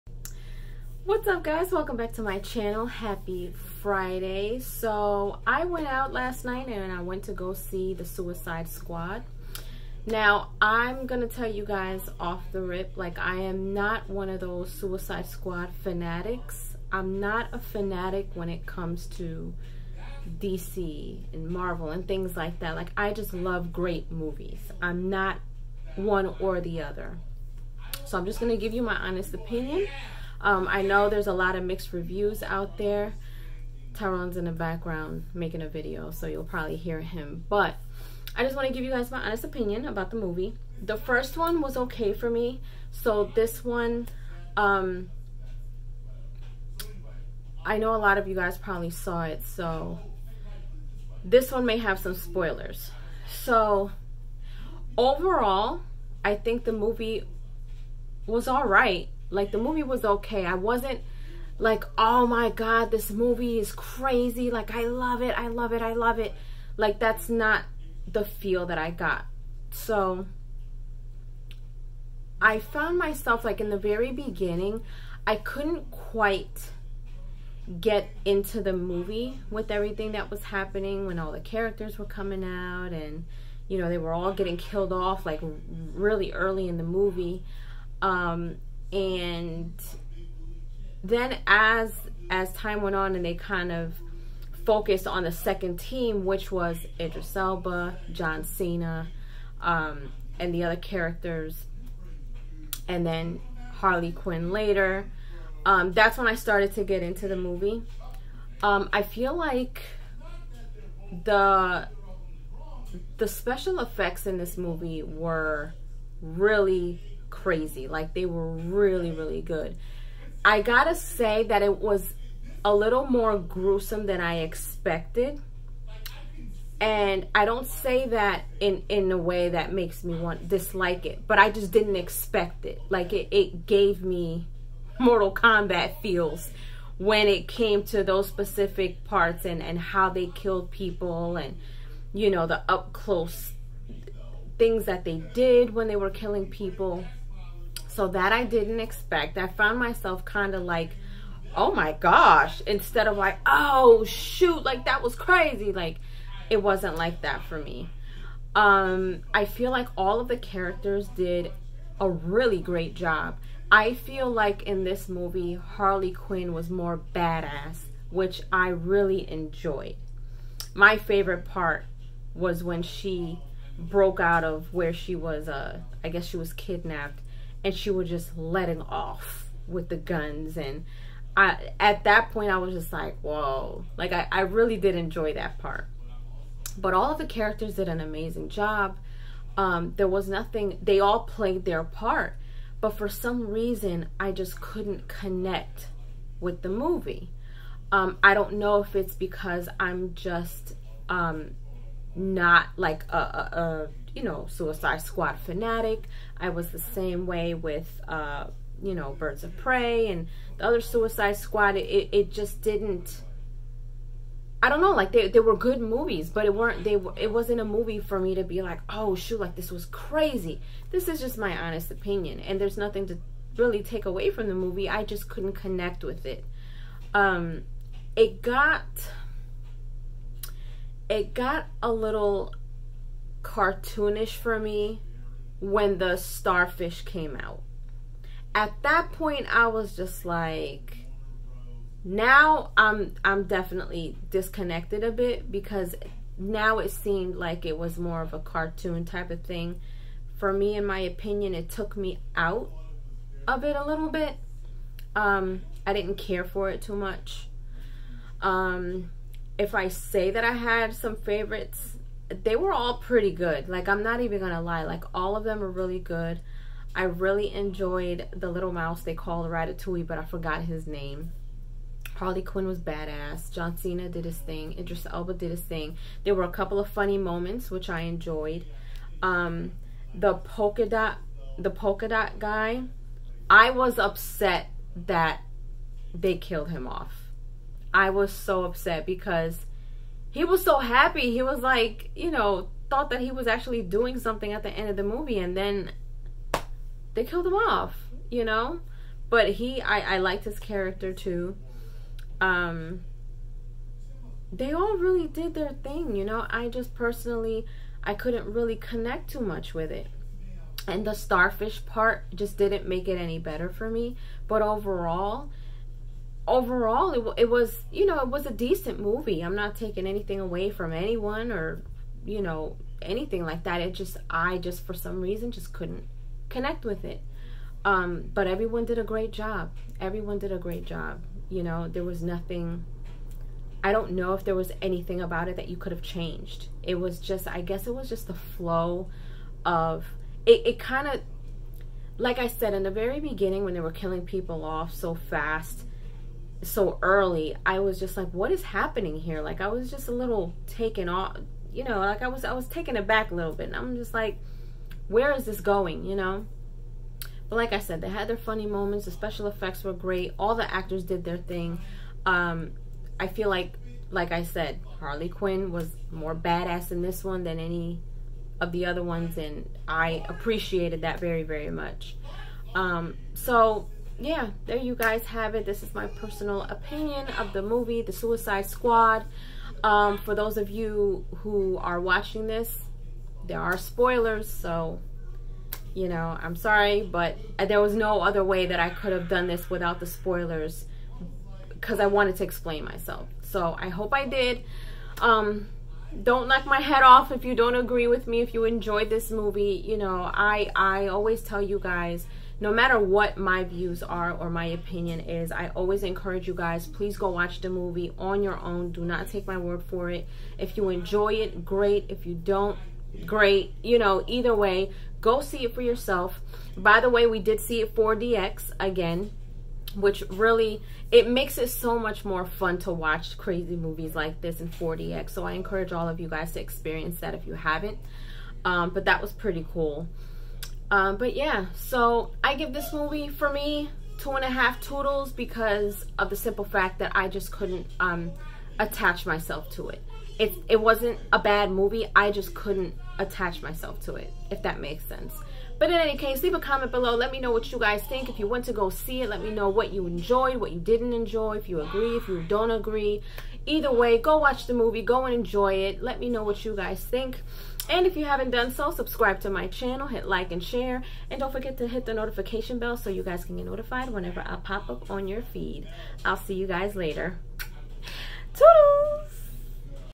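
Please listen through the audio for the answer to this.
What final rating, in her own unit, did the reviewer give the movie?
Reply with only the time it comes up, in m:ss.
7:14.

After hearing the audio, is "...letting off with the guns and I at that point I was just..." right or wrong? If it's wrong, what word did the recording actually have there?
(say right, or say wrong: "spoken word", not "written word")
right.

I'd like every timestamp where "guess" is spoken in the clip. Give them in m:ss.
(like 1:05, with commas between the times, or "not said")
2:56, 5:37.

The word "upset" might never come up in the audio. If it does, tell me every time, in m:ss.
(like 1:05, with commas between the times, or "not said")
4:43, 4:48.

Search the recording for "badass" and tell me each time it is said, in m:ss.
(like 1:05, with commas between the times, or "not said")
2:47, 4:32, 6:06.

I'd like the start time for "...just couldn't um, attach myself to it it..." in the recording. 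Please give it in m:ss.
7:17.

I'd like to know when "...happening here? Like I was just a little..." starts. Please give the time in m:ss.
5:48.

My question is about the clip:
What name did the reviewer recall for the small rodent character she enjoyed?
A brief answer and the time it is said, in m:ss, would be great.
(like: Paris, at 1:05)
Ratatouille, at 4:29.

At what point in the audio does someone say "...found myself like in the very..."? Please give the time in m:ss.
1:12.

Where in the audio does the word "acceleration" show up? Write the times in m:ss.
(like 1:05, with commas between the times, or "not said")
not said.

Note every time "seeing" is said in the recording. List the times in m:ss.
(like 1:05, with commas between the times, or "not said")
not said.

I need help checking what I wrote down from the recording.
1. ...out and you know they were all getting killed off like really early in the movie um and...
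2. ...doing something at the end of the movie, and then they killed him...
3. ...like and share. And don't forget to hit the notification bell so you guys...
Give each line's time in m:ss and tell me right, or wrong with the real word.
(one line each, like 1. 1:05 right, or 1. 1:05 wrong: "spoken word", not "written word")
1. 1:22 right
2. 4:53 right
3. 7:40 right.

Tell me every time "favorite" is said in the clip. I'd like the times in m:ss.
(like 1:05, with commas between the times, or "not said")
2:50, 4:21.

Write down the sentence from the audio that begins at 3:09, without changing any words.
Um, there was nothing they all played their part.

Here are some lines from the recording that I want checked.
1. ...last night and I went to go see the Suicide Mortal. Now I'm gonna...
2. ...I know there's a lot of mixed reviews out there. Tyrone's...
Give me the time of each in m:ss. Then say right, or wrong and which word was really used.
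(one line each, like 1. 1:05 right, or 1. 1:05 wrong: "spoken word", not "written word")
1. 0:06 wrong: "Squad", not "Mortal"
2. 0:30 right.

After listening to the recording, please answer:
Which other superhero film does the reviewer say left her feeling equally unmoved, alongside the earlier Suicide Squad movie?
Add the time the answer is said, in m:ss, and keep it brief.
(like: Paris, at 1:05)
Birds of Prey, at 3:29.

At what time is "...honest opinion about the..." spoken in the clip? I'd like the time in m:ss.
0:39.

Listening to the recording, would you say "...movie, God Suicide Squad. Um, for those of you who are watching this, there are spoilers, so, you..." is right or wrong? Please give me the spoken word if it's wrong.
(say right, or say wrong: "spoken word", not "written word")
wrong: "The", not "God".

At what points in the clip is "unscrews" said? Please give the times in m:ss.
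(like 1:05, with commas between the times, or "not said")
not said.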